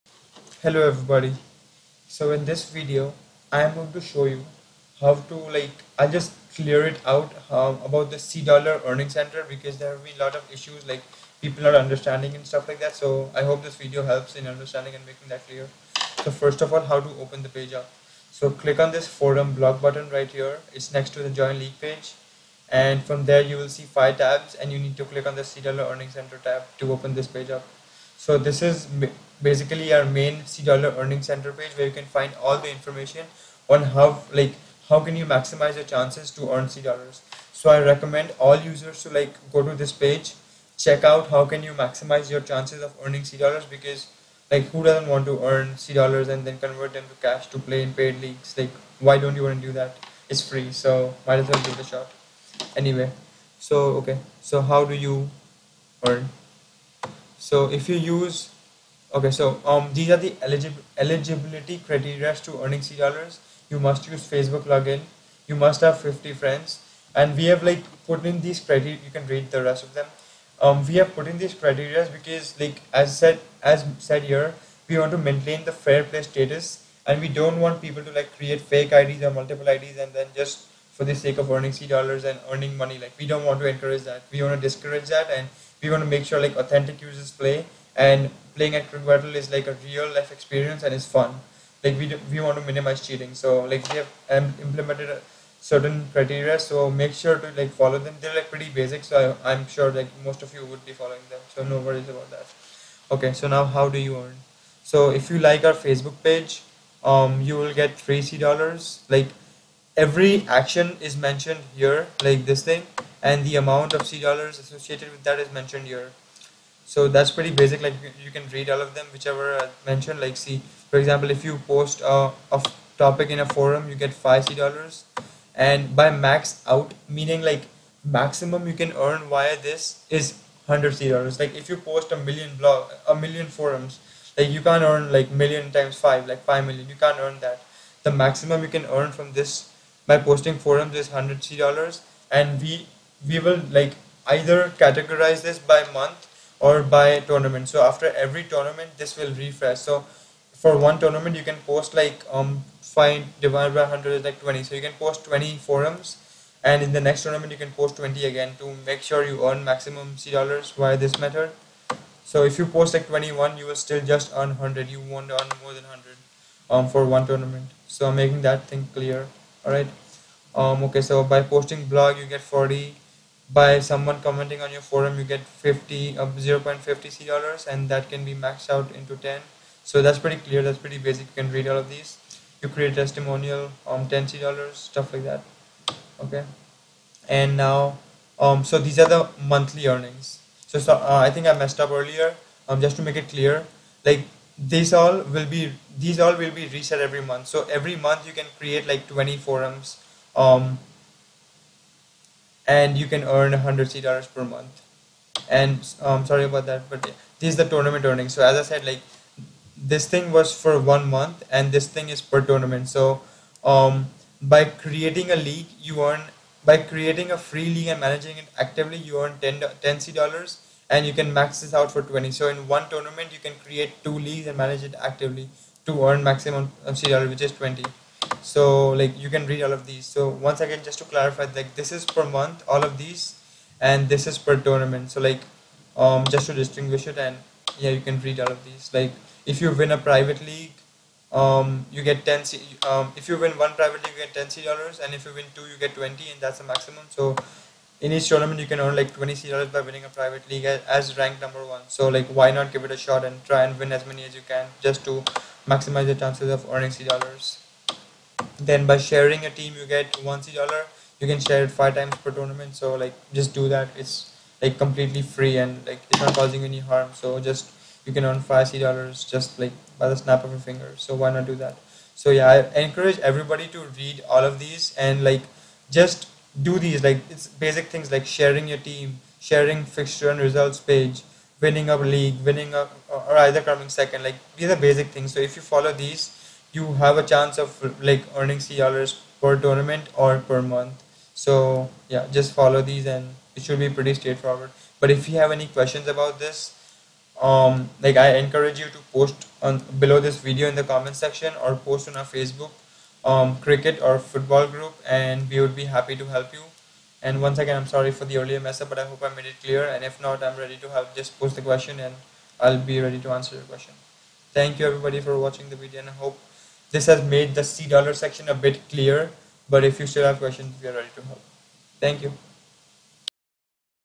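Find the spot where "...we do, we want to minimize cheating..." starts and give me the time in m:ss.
1:31.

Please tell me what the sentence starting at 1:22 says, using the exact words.
Like we don't want to encourage that.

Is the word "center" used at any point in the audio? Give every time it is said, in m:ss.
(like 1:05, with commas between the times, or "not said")
0:09, 0:26, 0:31.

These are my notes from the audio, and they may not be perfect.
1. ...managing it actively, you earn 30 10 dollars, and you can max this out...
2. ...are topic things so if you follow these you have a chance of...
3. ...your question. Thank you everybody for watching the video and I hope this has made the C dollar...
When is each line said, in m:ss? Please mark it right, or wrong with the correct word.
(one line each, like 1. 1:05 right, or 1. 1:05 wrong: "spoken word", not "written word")
1. 3:38 wrong: "10", not "30"
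2. 4:44 wrong: "basic", not "topic"
3. 5:13 right.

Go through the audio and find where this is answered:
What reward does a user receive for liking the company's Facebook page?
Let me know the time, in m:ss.
1:47.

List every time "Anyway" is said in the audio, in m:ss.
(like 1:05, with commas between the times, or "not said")
0:52.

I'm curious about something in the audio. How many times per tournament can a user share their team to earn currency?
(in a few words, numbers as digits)
5.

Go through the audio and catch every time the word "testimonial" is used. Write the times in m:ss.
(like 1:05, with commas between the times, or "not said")
3:02.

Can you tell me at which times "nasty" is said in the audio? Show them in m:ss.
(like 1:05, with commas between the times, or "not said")
not said.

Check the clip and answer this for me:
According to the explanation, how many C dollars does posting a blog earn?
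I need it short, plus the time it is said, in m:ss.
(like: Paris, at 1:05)
40, at 2:52.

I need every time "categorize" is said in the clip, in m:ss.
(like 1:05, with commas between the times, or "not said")
2:24.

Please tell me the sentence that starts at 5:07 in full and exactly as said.
And once again, I'm sorry for the earlier mess up, but I hope I made it clear.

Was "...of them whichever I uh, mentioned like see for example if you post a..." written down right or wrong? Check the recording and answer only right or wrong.
right.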